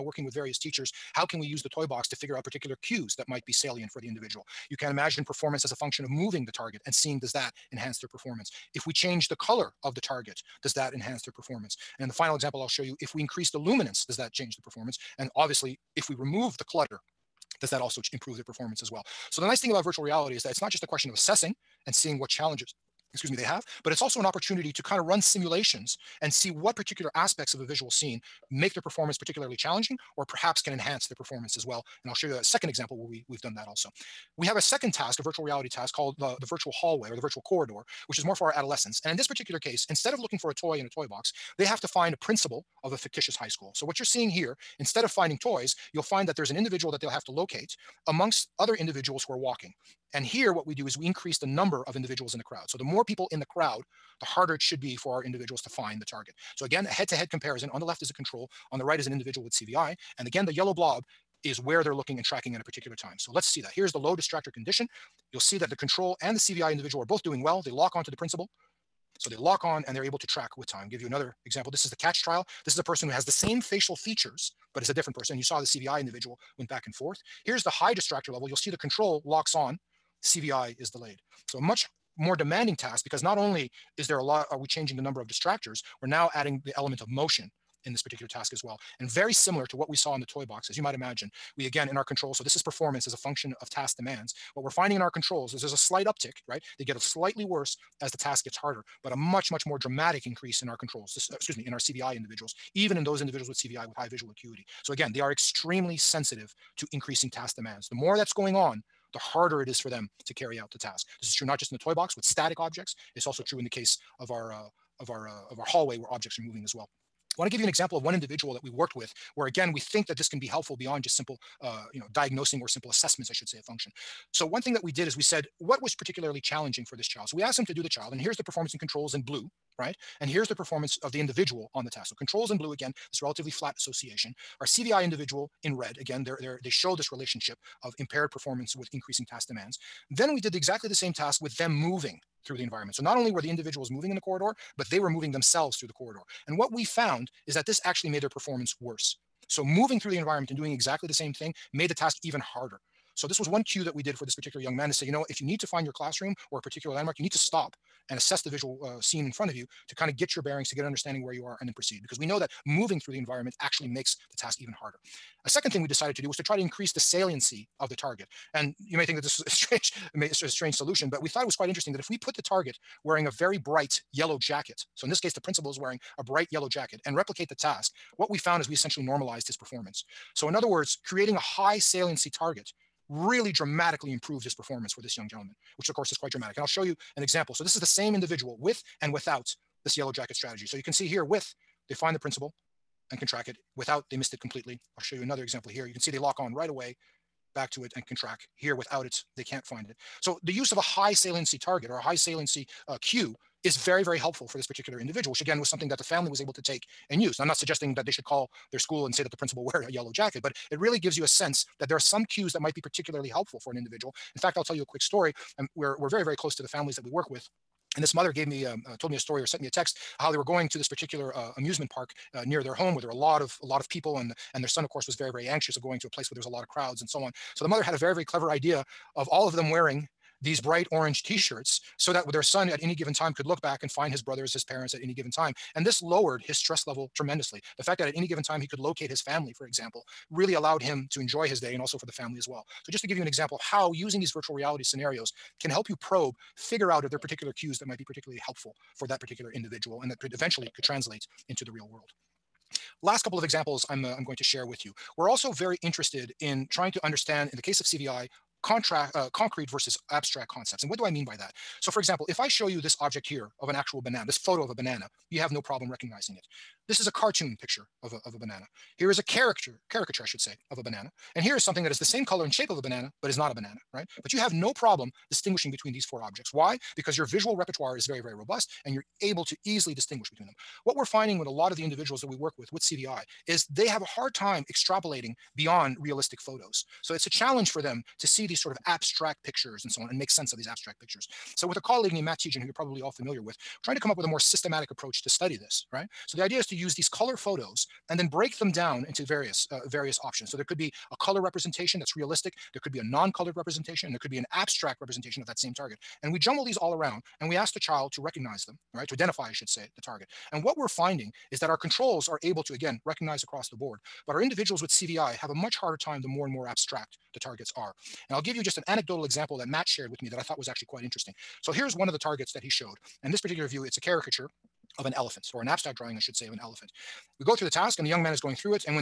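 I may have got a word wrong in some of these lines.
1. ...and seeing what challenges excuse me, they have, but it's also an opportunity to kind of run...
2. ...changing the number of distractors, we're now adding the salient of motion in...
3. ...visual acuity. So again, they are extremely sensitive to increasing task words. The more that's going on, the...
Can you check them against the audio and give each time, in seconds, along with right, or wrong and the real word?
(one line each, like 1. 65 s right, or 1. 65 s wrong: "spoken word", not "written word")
1. 21 s right
2. 84 s wrong: "element", not "salient"
3. 104 s wrong: "demands", not "words".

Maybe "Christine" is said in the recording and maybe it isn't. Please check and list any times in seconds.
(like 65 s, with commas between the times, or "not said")
not said.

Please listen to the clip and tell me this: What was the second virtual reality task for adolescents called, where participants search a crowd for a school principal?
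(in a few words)
virtual hallway.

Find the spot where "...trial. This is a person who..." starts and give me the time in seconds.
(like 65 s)
72 s.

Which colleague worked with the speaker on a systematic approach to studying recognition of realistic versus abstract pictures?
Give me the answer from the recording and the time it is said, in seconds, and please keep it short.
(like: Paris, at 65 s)
Matt Tietjen, at 292 s.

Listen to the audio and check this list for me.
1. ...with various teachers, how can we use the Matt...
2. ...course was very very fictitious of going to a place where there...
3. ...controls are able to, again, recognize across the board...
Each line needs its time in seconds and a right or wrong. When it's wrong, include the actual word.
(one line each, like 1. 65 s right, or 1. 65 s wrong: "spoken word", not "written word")
1. 0 s wrong: "Toy", not "Matt"
2. 224 s wrong: "anxious", not "fictitious"
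3. 311 s right.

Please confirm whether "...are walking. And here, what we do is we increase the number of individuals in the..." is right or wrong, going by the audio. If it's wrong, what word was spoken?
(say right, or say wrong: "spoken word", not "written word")
right.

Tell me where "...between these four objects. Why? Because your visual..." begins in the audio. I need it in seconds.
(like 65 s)
275 s.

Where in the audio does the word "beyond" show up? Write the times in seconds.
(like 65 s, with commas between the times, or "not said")
120 s, 285 s.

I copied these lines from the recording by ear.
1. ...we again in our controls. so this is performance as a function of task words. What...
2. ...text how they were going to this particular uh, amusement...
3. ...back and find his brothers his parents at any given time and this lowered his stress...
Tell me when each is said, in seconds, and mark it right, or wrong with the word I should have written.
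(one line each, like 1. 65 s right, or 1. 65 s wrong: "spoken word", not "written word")
1. 91 s wrong: "demands", not "words"
2. 219 s right
3. 233 s right.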